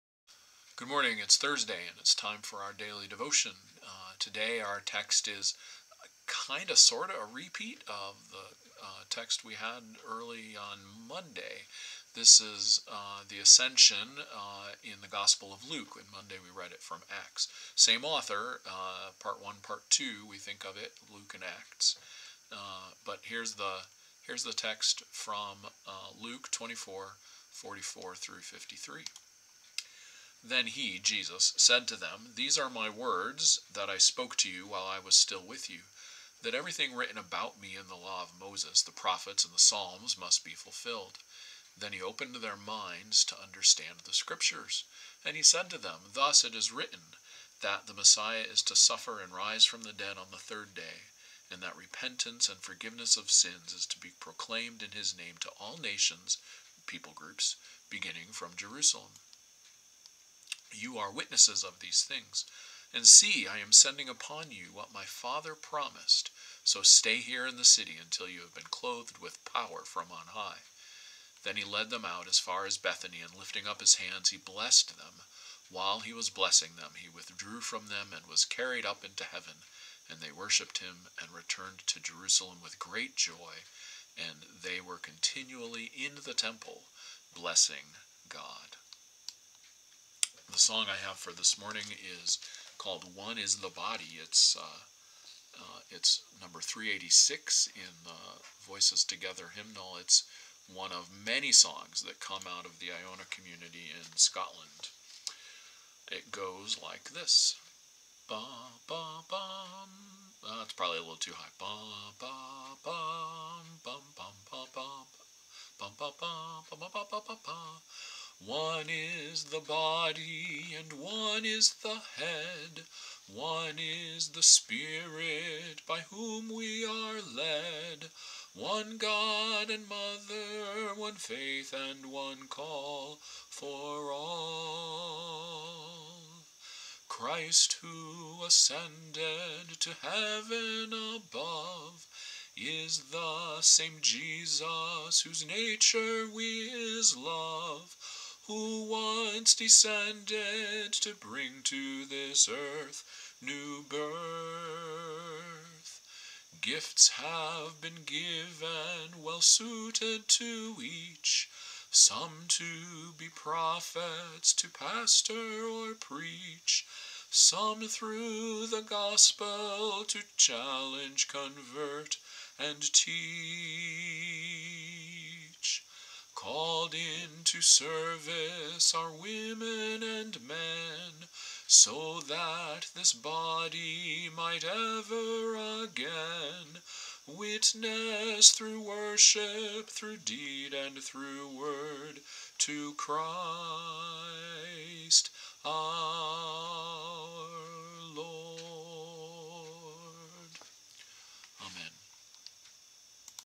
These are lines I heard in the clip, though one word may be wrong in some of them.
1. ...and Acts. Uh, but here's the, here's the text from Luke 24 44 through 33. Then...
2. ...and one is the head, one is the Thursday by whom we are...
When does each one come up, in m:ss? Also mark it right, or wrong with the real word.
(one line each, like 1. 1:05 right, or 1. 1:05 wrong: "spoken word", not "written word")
1. 0:21 wrong: "53", not "33"
2. 2:00 wrong: "Spirit", not "Thursday".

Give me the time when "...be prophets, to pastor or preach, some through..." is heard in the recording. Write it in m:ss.
2:43.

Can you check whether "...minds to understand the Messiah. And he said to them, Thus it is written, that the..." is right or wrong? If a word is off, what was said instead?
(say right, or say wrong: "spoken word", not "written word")
wrong: "Scriptures", not "Messiah".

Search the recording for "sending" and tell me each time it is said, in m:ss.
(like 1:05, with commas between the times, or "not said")
1:03.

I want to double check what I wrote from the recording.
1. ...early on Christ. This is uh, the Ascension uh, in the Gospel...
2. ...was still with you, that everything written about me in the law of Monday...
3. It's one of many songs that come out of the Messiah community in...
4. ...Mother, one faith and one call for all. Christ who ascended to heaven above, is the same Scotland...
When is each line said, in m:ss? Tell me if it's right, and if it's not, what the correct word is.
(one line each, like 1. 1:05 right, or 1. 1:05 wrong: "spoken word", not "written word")
1. 0:10 wrong: "Monday", not "Christ"
2. 0:34 wrong: "Moses", not "Monday"
3. 1:39 wrong: "Iona", not "Messiah"
4. 2:09 wrong: "Jesus", not "Scotland".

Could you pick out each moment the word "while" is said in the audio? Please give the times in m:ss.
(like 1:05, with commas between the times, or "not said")
0:34, 1:15.